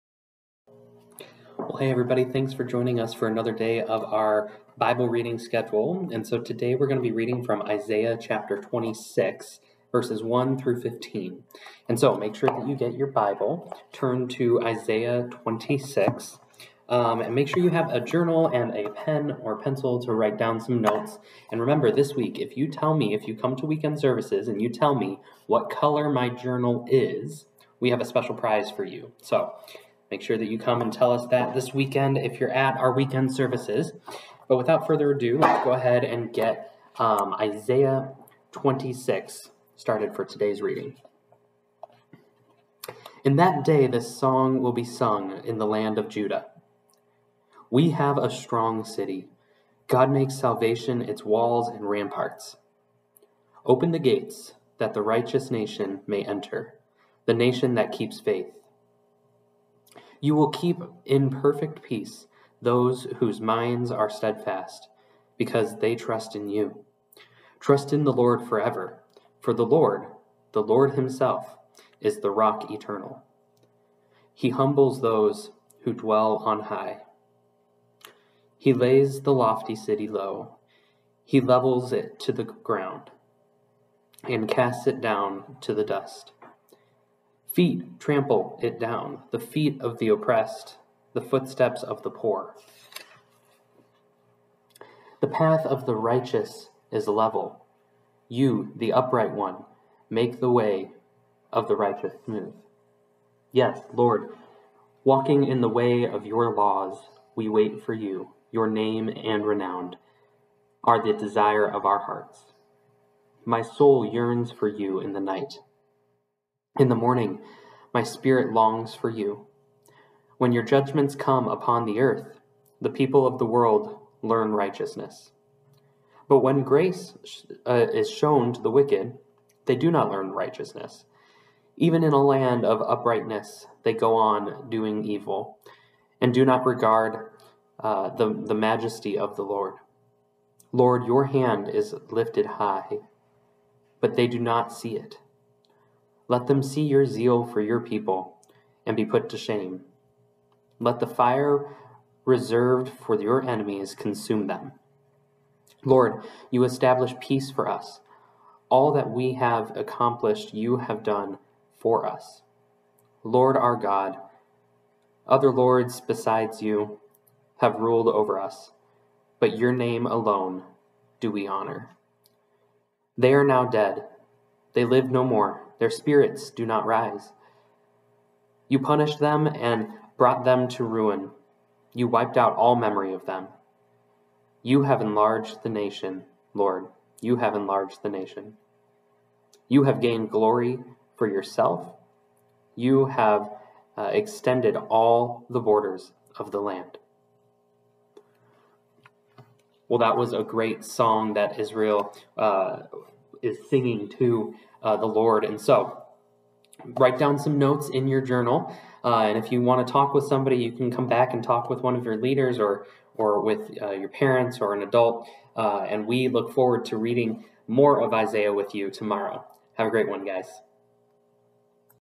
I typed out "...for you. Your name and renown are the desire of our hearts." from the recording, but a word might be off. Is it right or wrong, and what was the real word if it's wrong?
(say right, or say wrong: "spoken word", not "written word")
right.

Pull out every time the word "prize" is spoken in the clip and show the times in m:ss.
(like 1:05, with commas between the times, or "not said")
0:28.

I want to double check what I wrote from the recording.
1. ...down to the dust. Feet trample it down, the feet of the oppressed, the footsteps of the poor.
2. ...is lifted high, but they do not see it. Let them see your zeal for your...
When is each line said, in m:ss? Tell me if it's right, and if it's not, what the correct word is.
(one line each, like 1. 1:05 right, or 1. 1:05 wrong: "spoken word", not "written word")
1. 1:25 right
2. 2:21 right.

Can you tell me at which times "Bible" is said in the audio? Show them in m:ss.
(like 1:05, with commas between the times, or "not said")
0:04, 0:13.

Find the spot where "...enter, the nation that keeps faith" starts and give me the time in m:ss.
0:56.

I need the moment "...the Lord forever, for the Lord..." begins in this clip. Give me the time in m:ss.
1:08.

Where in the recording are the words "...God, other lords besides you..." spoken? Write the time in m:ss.
2:43.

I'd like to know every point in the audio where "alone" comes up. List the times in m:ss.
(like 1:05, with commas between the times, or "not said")
2:50.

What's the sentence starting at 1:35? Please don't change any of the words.
The path of the righteous is level.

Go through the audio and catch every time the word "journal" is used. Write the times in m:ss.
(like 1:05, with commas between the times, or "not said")
0:18, 0:26, 3:28.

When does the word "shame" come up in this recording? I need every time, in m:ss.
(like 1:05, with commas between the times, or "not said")
2:29.